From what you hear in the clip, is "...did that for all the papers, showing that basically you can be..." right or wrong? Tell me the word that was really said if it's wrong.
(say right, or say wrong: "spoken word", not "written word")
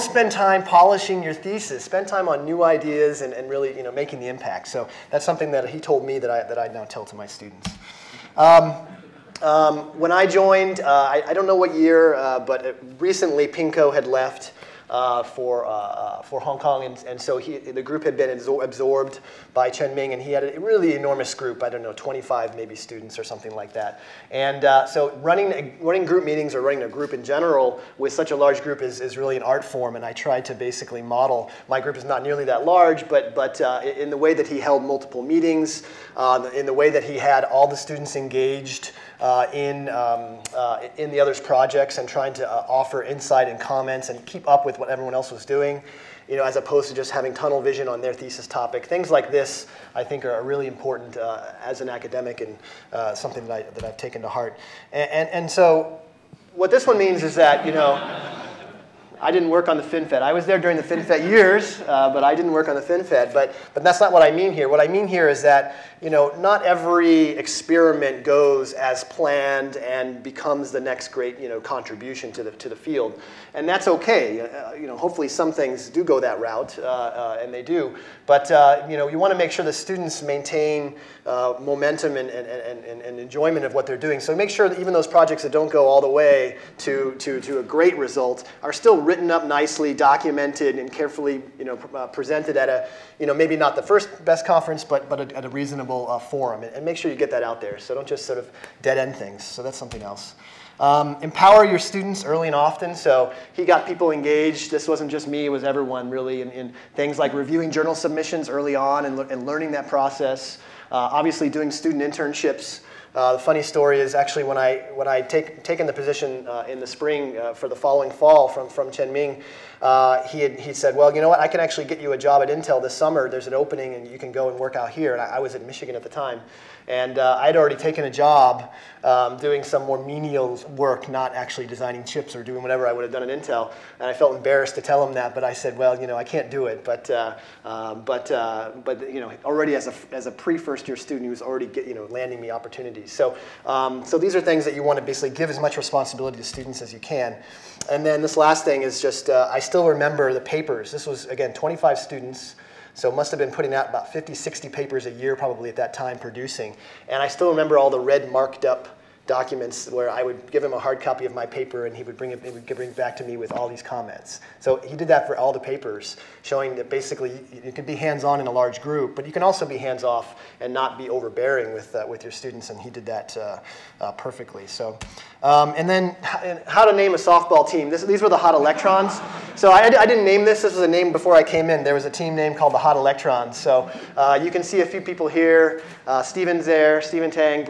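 right.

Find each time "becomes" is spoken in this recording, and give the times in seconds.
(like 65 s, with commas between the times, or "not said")
70 s.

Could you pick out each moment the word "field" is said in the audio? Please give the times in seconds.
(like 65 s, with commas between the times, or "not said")
72 s.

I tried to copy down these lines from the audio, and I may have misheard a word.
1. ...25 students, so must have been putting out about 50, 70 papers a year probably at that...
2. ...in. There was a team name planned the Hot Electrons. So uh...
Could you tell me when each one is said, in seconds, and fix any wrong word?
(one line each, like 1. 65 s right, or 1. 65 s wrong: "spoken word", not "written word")
1. 151 s wrong: "60", not "70"
2. 181 s wrong: "called", not "planned".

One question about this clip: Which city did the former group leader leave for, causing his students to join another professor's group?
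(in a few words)
Hong Kong.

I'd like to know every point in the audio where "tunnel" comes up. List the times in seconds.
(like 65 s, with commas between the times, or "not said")
47 s.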